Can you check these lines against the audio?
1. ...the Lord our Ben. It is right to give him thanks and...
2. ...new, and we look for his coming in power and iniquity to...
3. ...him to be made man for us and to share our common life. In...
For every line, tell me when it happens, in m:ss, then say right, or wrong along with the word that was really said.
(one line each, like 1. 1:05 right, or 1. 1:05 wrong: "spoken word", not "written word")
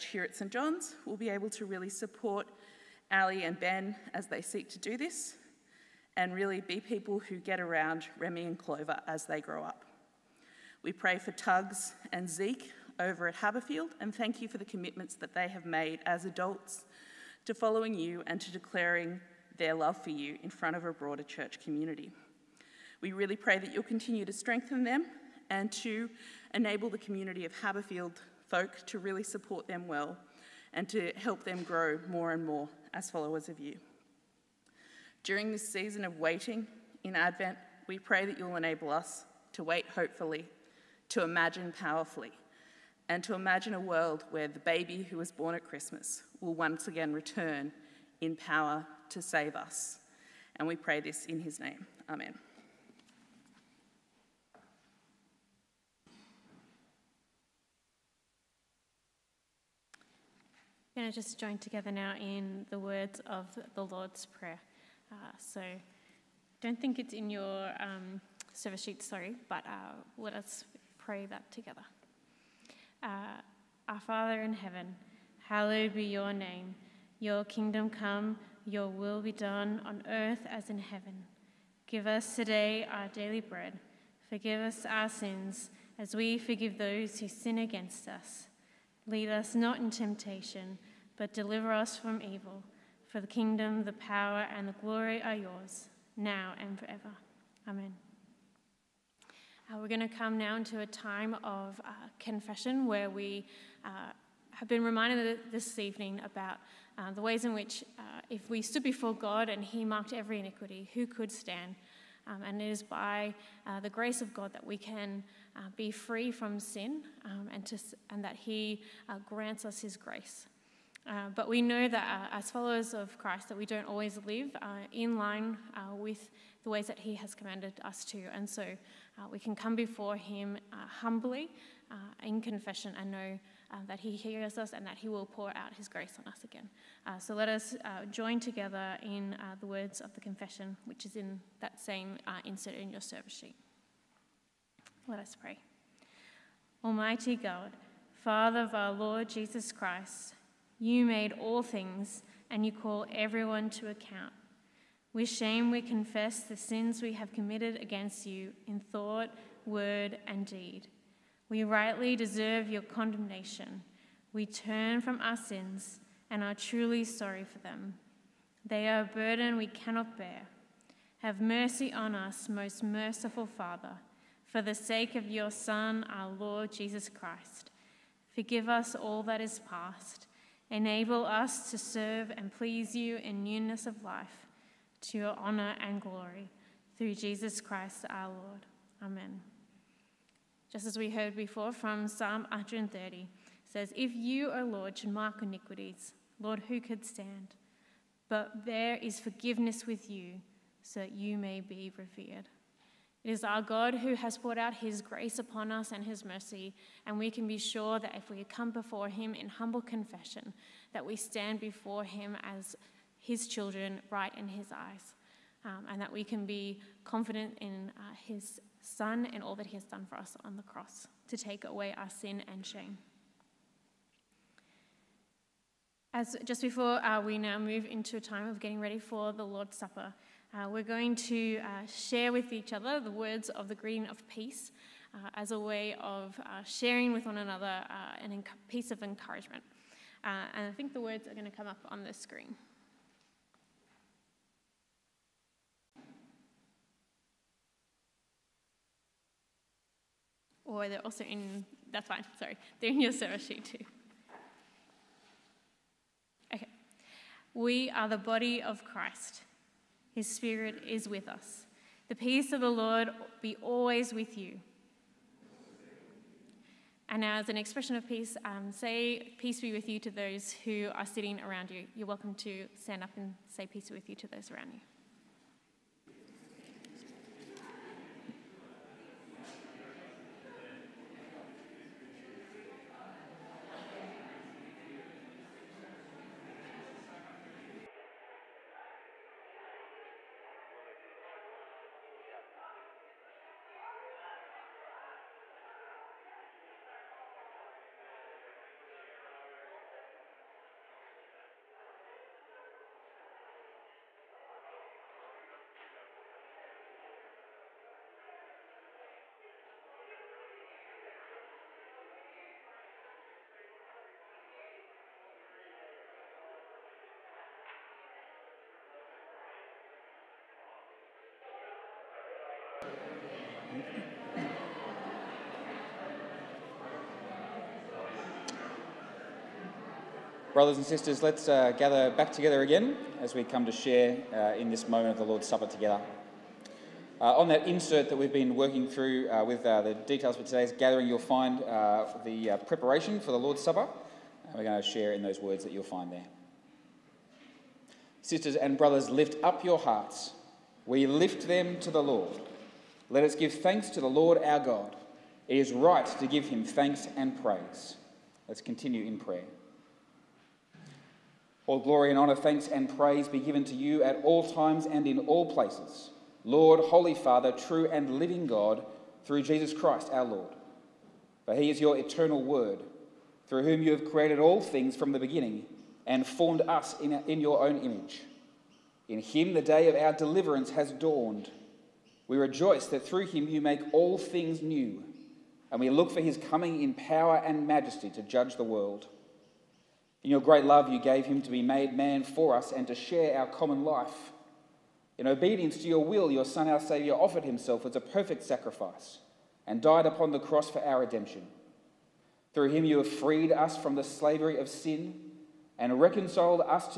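1. 5:54 wrong: "God", not "Ben"
2. 6:24 wrong: "majesty", not "iniquity"
3. 6:31 right.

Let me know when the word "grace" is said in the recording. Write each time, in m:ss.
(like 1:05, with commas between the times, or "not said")
1:53, 1:59, 2:15, 3:25.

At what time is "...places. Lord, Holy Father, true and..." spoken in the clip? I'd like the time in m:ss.
6:05.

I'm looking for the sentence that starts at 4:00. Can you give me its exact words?
Uh, and I think the words are going to come up on the screen.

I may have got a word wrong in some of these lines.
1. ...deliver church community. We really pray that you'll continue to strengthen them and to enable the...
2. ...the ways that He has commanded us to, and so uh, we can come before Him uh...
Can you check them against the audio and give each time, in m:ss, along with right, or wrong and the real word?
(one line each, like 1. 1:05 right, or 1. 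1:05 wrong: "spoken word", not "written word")
1. 0:20 wrong: "broader", not "deliver"
2. 2:06 right.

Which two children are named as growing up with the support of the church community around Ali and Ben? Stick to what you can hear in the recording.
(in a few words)
Remy and Clover.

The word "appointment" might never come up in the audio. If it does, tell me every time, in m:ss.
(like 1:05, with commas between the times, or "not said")
not said.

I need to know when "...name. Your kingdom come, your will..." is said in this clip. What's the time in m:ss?
1:16.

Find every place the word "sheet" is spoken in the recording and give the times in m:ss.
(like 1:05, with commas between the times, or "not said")
1:08, 2:23, 4:13.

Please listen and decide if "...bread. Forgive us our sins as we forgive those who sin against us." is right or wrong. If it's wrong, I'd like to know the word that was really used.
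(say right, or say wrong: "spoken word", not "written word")
right.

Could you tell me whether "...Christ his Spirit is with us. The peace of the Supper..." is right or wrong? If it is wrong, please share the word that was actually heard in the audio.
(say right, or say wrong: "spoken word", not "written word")
wrong: "Lord", not "Supper".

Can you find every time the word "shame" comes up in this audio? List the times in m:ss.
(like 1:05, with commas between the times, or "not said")
2:35, 3:42.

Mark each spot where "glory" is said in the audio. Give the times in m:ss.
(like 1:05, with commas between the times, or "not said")
1:34, 3:06, 6:01.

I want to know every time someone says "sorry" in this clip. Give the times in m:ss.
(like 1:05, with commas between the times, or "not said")
1:09, 2:47, 4:12.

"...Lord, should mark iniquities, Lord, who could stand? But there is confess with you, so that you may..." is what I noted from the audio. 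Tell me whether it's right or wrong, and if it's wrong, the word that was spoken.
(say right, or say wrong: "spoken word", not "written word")
wrong: "forgiveness", not "confess".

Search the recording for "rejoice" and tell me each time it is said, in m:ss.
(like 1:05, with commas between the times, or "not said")
6:22.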